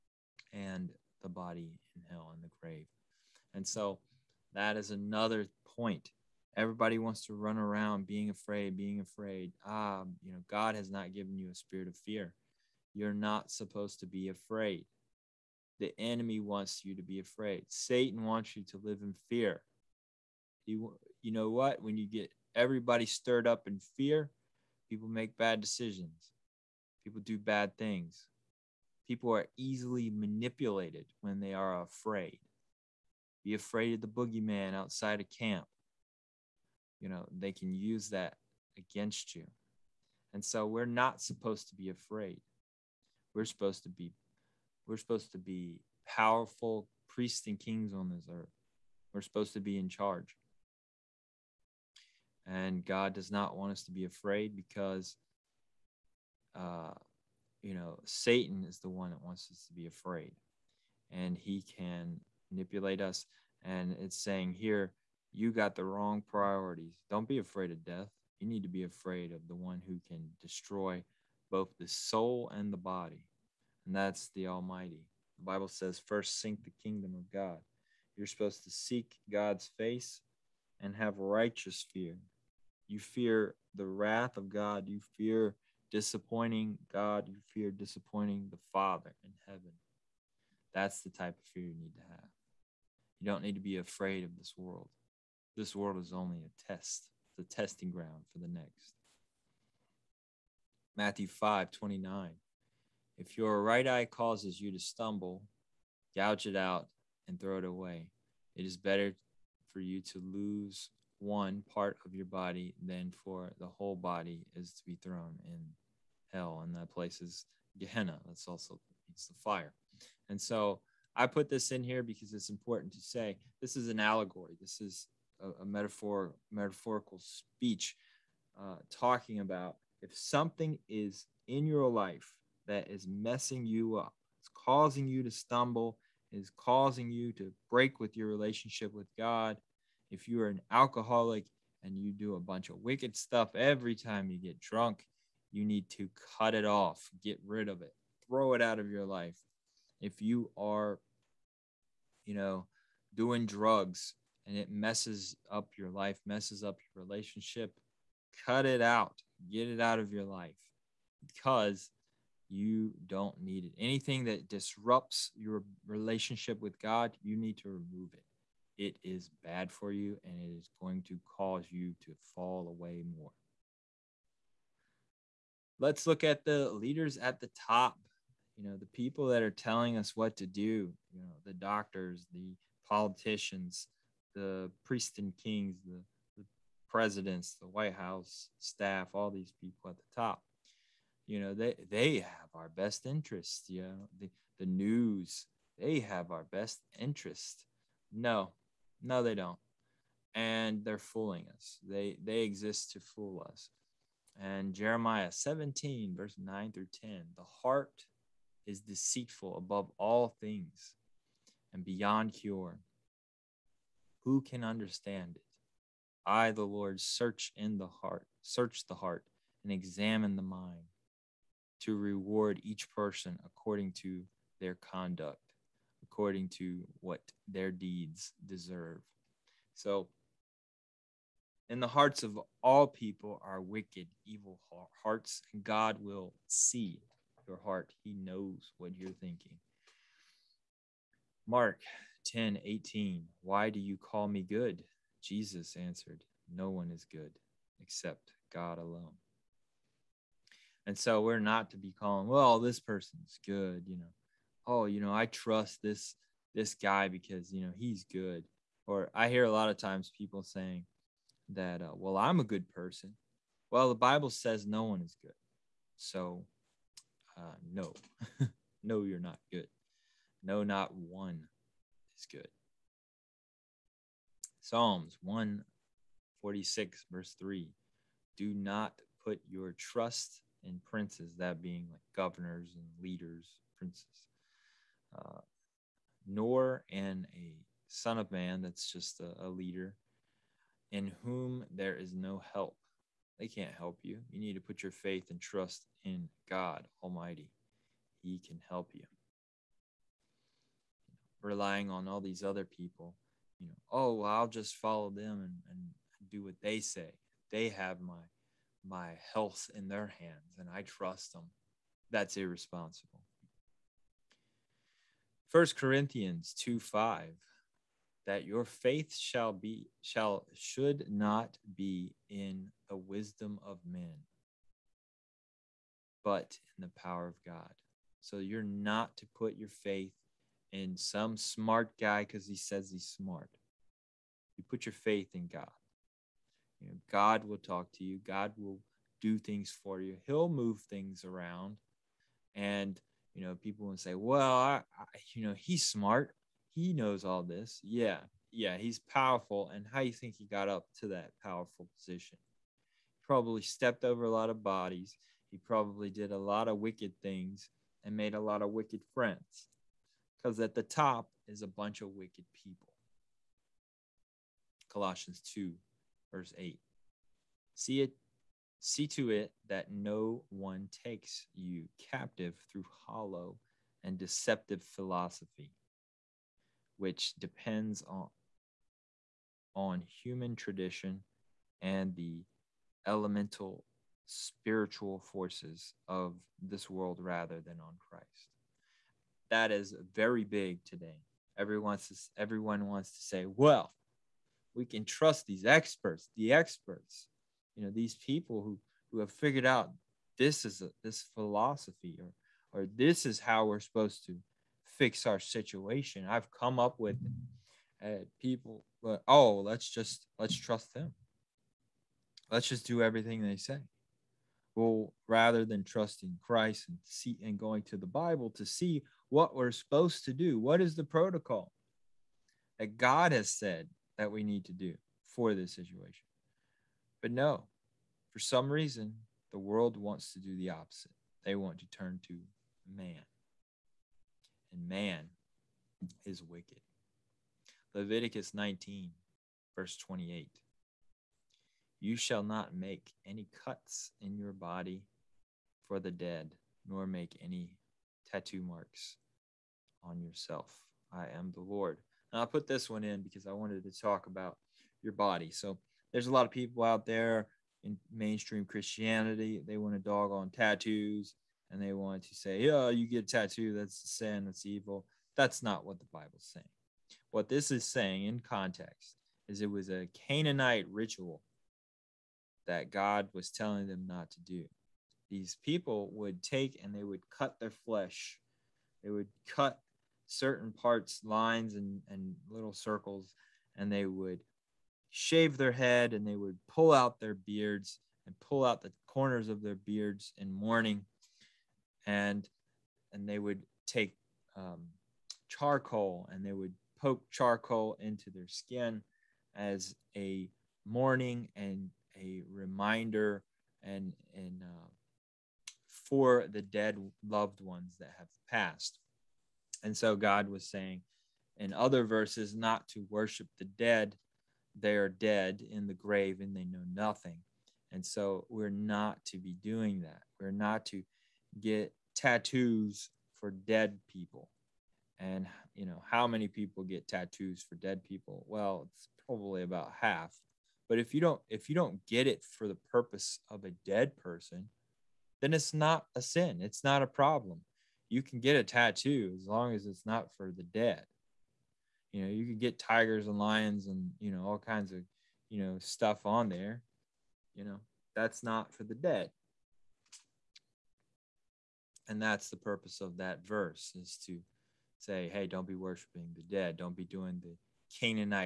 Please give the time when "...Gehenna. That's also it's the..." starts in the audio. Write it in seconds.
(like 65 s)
117 s.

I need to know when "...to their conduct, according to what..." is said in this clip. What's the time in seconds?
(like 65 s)
223 s.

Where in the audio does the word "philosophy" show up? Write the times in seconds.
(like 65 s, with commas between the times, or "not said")
374 s, 401 s.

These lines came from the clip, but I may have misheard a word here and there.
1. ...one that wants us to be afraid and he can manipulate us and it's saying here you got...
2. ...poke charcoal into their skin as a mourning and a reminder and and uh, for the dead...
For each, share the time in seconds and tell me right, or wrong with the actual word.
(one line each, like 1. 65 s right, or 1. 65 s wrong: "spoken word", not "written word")
1. 58 s right
2. 496 s right.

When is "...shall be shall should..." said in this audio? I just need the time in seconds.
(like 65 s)
319 s.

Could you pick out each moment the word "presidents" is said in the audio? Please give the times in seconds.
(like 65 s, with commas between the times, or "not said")
186 s.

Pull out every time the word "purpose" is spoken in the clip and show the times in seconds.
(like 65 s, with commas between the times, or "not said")
532 s, 552 s.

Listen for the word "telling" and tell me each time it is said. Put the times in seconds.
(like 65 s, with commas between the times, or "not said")
179 s, 473 s.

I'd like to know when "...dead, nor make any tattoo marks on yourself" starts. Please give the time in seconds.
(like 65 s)
446 s.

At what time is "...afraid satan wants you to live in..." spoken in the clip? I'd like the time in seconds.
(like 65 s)
17 s.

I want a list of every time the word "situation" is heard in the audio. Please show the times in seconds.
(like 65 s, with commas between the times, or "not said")
405 s, 425 s.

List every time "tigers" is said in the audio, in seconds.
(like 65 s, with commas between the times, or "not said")
542 s.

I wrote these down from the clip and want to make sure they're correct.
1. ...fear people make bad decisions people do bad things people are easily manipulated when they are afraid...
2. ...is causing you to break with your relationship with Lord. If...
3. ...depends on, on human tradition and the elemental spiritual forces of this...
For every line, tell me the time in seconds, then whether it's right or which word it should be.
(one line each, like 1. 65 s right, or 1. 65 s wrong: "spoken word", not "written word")
1. 23 s right
2. 136 s wrong: "God", not "Lord"
3. 377 s right.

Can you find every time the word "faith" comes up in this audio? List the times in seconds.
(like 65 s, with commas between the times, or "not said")
294 s, 318 s, 329 s, 334 s.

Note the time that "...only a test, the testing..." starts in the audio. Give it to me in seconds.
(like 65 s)
96 s.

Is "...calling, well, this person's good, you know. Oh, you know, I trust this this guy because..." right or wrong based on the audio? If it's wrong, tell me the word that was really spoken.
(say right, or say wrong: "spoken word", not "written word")
right.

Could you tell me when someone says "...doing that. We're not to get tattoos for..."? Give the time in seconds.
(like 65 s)
519 s.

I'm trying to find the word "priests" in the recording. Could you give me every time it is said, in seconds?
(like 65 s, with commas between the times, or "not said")
47 s, 184 s.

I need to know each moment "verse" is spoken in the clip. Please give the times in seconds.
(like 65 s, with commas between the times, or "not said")
206 s, 277 s, 366 s, 439 s, 512 s, 553 s.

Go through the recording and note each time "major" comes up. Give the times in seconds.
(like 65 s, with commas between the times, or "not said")
not said.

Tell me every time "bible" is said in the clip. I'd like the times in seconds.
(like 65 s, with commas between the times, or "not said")
75 s, 263 s, 418 s, 466 s.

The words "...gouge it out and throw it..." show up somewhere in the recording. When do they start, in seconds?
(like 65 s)
106 s.